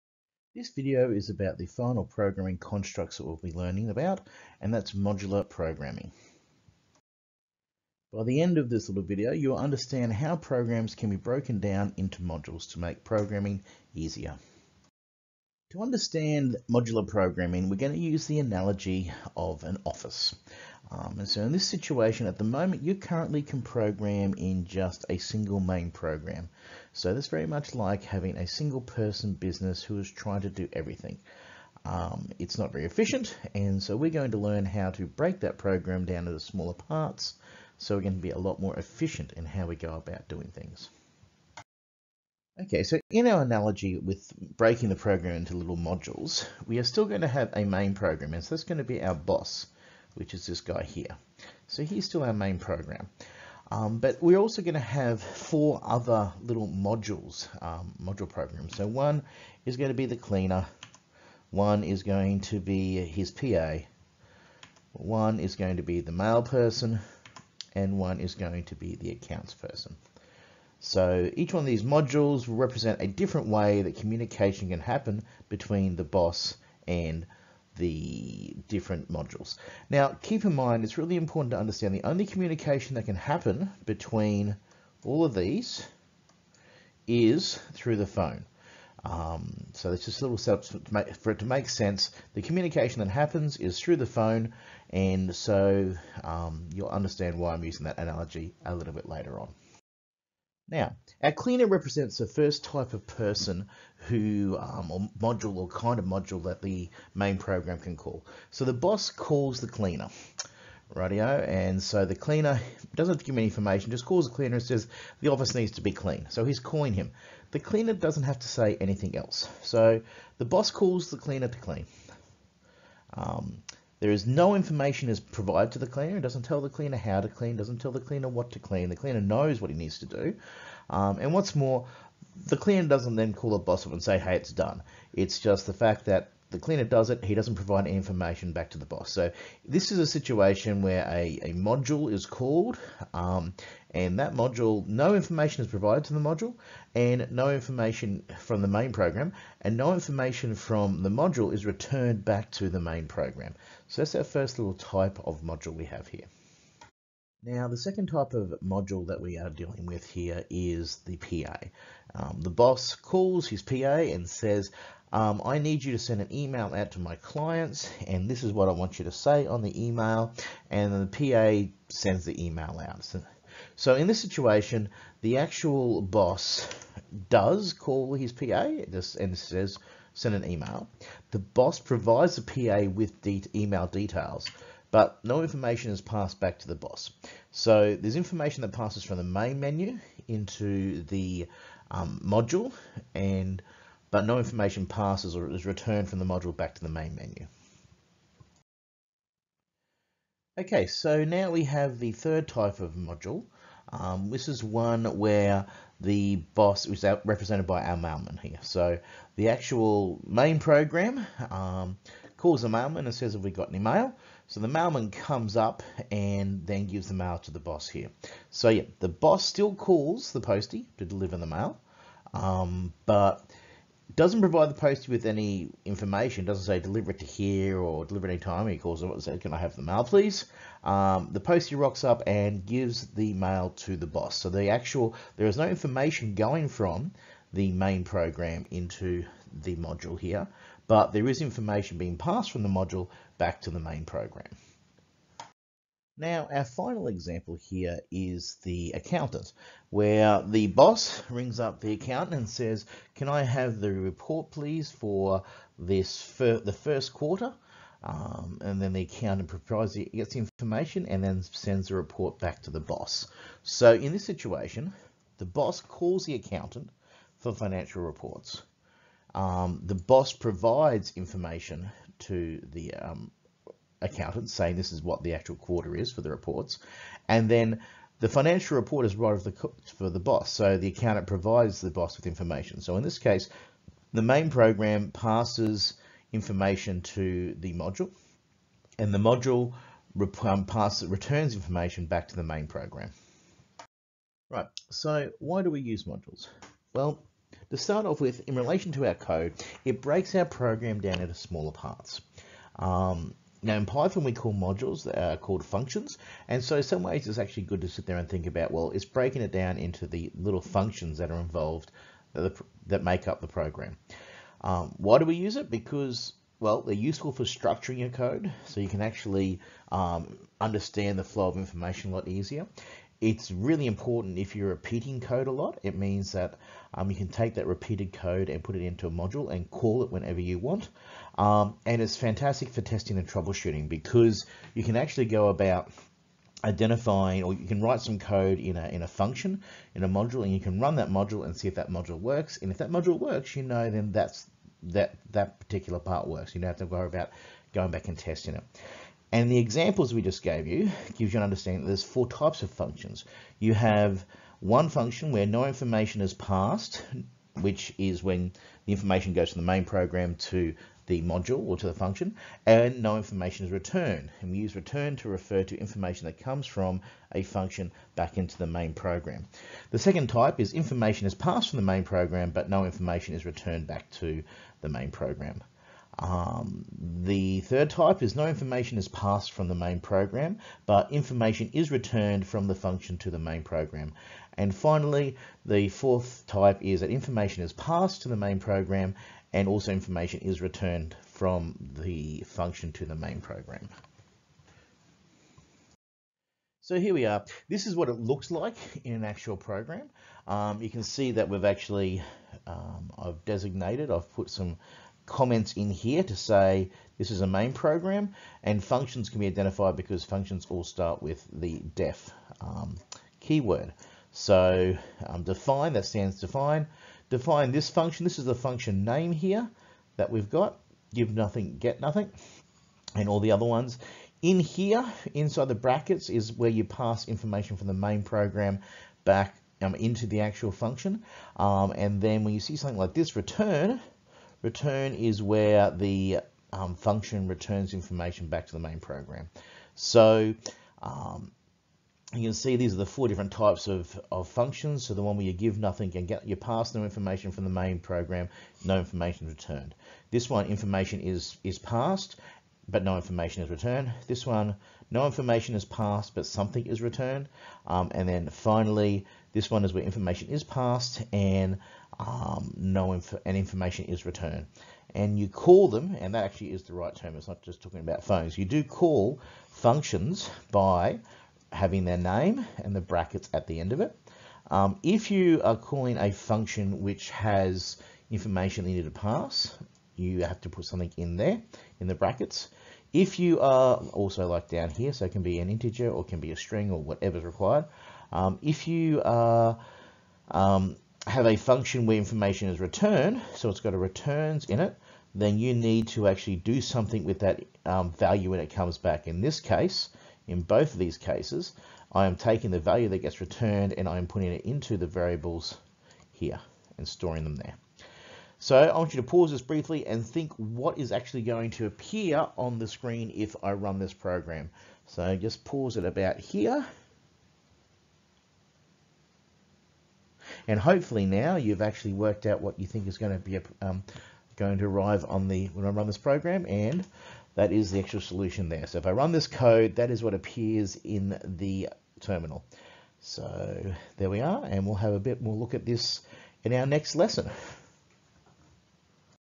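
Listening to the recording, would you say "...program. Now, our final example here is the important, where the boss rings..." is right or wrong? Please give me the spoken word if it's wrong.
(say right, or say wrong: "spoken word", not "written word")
wrong: "accountant", not "important".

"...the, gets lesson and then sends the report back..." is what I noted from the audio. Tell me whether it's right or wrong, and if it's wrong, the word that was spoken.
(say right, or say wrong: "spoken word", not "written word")
wrong: "information", not "lesson".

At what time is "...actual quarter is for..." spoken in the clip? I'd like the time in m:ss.
4:35.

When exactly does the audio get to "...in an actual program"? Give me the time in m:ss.
6:39.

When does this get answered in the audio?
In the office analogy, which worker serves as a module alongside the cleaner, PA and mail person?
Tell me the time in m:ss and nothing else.
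1:09.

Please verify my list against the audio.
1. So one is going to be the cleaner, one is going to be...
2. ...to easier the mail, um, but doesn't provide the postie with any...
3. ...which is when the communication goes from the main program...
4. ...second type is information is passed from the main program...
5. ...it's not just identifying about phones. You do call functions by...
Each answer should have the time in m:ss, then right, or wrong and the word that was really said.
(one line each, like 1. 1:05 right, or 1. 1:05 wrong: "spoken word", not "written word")
1. 0:58 right
2. 3:40 wrong: "deliver", not "easier"
3. 5:57 wrong: "information", not "communication"
4. 6:09 right
5. 7:47 wrong: "talking", not "identifying".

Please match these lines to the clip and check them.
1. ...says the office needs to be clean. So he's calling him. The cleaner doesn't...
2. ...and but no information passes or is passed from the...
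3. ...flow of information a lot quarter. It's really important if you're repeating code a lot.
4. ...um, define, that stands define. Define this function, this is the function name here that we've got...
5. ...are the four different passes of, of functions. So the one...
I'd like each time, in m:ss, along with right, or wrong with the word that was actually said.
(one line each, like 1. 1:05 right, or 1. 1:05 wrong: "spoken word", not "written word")
1. 1:54 right
2. 3:13 wrong: "returned", not "passed"
3. 5:21 wrong: "easier", not "quarter"
4. 6:55 right
5. 7:22 wrong: "types", not "passes".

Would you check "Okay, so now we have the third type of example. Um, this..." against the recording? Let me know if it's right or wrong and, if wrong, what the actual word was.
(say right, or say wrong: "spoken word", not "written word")
wrong: "module", not "example".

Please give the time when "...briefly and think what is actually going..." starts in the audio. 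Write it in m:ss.
8:29.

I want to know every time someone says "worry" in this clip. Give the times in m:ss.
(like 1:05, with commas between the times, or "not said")
5:46.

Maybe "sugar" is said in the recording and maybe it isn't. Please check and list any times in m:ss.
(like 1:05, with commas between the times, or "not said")
not said.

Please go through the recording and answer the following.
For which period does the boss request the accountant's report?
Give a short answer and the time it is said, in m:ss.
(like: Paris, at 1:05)
the first quarter, at 4:16.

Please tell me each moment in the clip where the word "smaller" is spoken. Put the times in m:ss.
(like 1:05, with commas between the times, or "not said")
0:36, 5:01.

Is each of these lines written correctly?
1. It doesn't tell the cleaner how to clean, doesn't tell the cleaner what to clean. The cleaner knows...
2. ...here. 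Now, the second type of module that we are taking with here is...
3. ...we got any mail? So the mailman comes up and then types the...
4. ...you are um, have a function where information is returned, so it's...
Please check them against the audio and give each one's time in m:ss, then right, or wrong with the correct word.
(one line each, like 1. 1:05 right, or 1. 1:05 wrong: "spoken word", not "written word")
1. 2:06 right
2. 2:36 wrong: "dealing", not "taking"
3. 3:33 wrong: "gives", not "types"
4. 8:08 right.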